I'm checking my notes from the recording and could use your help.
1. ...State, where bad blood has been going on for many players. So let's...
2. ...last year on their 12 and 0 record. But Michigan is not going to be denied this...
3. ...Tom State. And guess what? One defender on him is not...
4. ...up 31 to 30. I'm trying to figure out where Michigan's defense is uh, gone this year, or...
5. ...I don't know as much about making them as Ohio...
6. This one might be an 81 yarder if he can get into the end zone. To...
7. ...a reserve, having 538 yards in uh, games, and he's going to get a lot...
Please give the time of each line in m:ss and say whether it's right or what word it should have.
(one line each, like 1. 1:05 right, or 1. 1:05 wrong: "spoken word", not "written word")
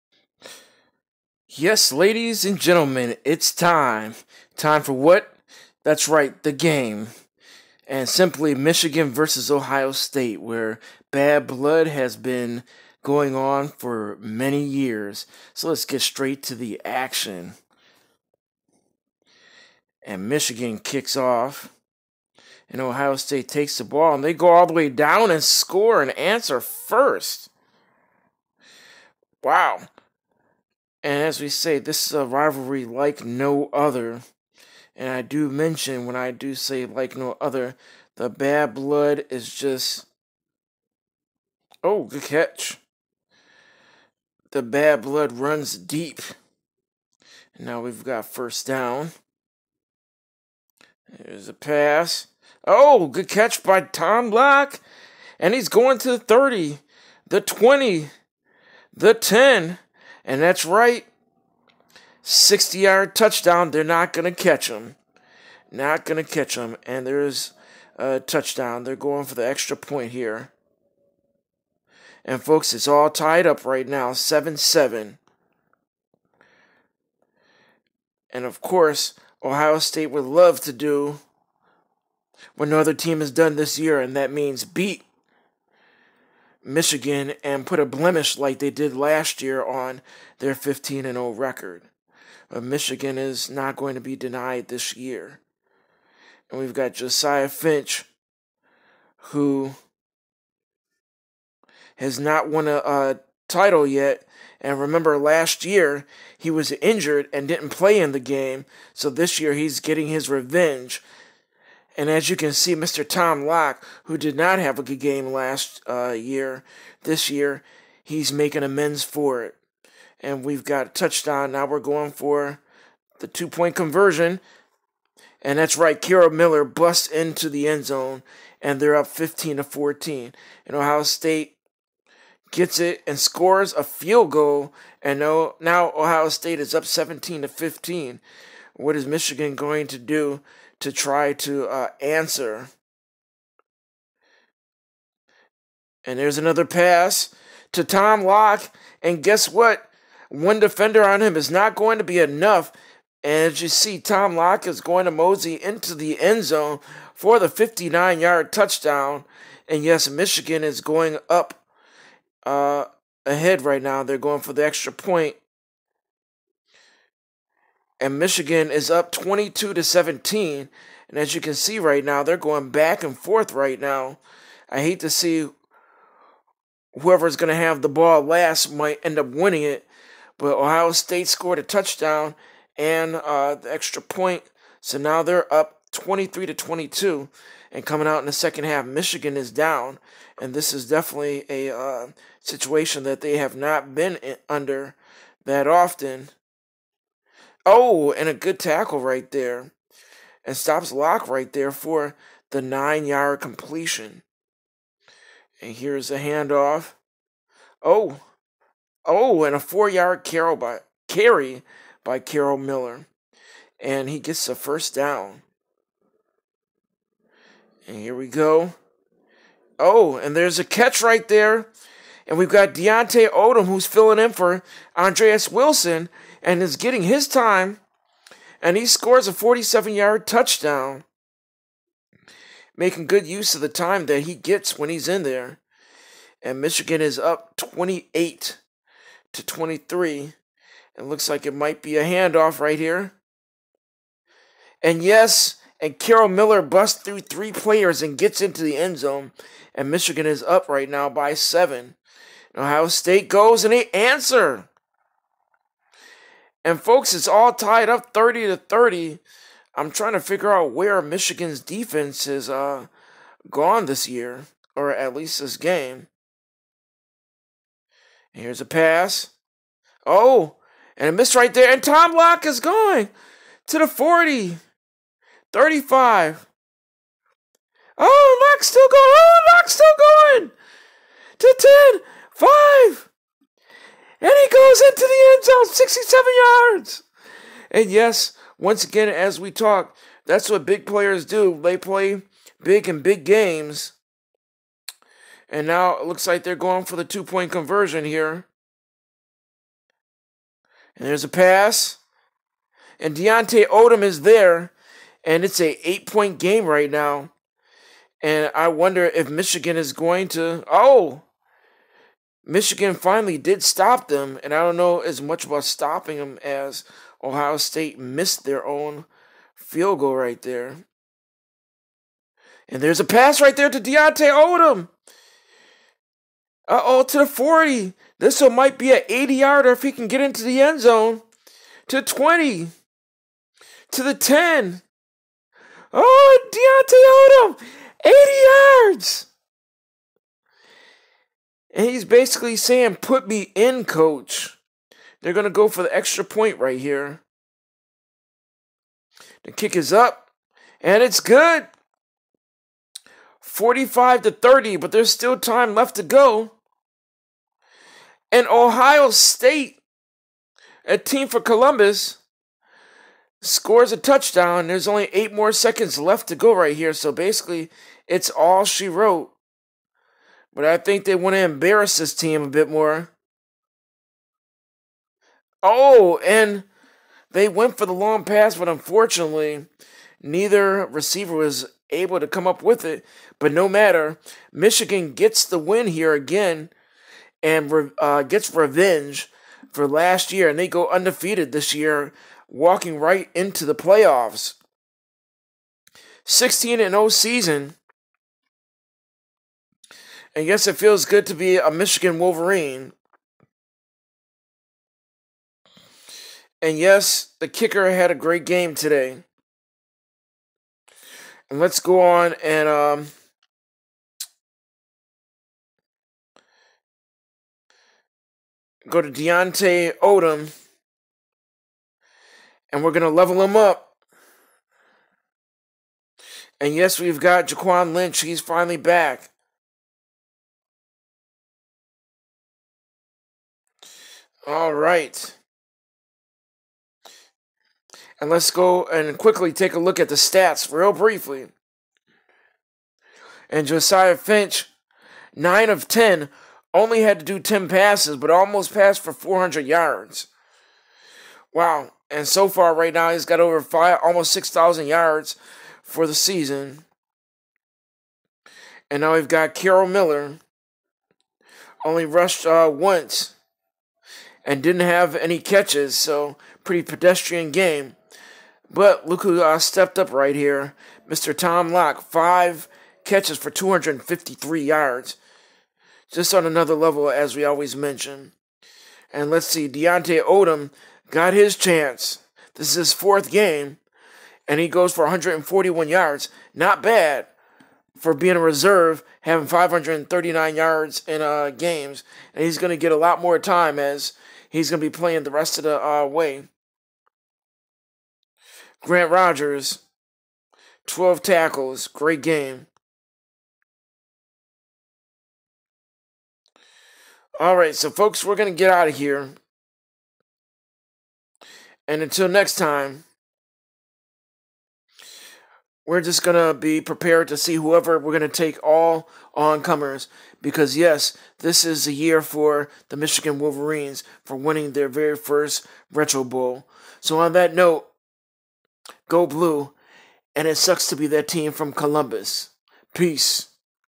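1. 0:09 wrong: "years", not "players"
2. 1:28 wrong: "15", not "12"
3. 2:27 wrong: "Locke", not "State"
4. 4:17 wrong: "30", not "31"
5. 5:14 wrong: "stopping", not "making"
6. 5:28 wrong: "80", not "81"
7. 8:08 wrong: "539", not "538".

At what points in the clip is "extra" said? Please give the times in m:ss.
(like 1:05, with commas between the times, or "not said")
1:09, 2:44, 3:03, 5:45.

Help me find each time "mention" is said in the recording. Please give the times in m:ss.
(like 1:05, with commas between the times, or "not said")
0:35, 7:57.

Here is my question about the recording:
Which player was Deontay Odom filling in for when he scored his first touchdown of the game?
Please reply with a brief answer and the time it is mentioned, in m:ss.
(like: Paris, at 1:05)
Andreas Wilson, at 3:44.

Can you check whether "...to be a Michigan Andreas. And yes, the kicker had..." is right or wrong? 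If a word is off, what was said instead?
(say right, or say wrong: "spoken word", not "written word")
wrong: "Wolverine", not "Andreas".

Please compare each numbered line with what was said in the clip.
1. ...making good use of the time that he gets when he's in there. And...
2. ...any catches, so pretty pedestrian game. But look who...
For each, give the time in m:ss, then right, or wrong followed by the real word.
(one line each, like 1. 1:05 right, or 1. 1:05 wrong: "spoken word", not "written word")
1. 3:52 right
2. 7:45 right.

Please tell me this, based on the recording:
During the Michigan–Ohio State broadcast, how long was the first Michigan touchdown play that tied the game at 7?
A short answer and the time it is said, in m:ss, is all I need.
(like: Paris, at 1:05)
60 yards, at 1:02.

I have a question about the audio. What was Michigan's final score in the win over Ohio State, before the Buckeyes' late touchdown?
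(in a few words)
45.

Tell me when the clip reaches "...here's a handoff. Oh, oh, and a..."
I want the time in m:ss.
3:25.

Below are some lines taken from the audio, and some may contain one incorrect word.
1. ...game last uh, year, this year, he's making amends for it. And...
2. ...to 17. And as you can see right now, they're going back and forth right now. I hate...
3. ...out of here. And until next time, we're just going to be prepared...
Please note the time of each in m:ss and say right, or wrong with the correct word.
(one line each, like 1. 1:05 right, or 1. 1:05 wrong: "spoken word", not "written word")
1. 1:54 right
2. 2:49 right
3. 8:28 right.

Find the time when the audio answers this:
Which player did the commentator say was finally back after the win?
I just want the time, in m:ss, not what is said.
7:07.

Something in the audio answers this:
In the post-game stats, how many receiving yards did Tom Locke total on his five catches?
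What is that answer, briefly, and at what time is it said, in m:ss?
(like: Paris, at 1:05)
253, at 7:53.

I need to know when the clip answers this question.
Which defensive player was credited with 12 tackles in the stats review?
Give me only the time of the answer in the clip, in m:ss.
8:18.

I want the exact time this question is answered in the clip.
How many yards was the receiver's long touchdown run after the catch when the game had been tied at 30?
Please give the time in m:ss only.
4:45.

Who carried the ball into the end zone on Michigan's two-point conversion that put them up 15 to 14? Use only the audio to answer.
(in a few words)
Kira Miller.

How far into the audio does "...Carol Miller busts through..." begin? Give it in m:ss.
4:05.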